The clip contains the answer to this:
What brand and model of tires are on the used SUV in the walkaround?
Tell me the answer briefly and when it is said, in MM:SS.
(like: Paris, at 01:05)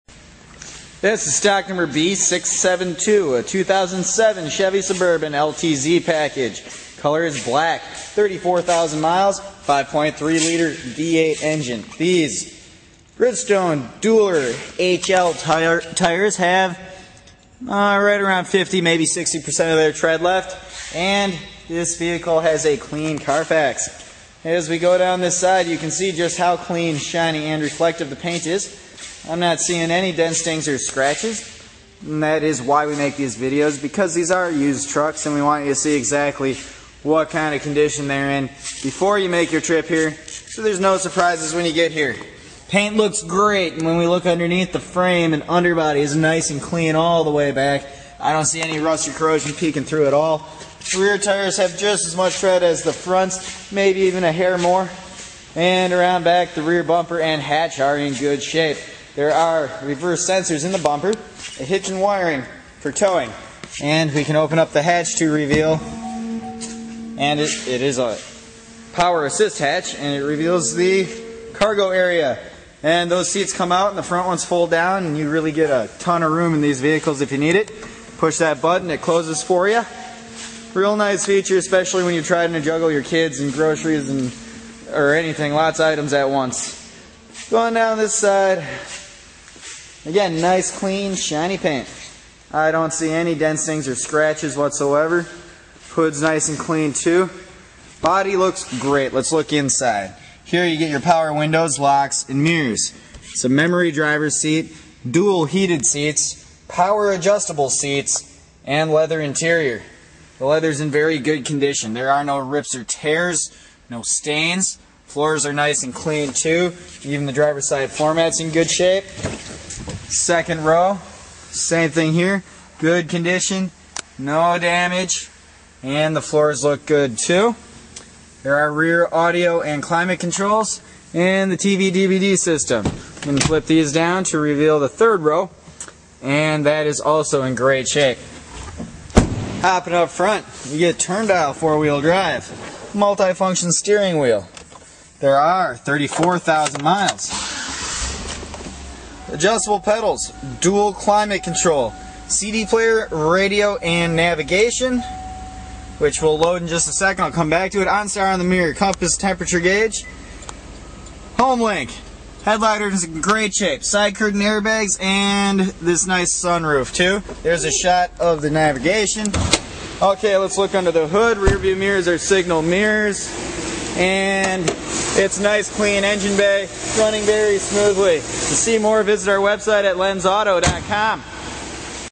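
Bridgestone Dueler HL, at 00:13.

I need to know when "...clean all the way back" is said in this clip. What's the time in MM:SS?
00:46.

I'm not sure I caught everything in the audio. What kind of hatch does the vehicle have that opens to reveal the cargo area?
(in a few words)
power assist hatch.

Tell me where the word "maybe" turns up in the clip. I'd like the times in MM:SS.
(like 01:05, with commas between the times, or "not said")
00:18, 00:53.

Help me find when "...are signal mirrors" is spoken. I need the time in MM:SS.
02:52.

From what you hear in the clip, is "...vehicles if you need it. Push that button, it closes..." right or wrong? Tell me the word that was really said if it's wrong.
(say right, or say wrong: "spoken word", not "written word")
right.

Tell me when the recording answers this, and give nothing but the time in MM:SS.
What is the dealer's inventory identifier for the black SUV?
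00:01.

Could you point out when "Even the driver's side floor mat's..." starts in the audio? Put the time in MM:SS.
01:57.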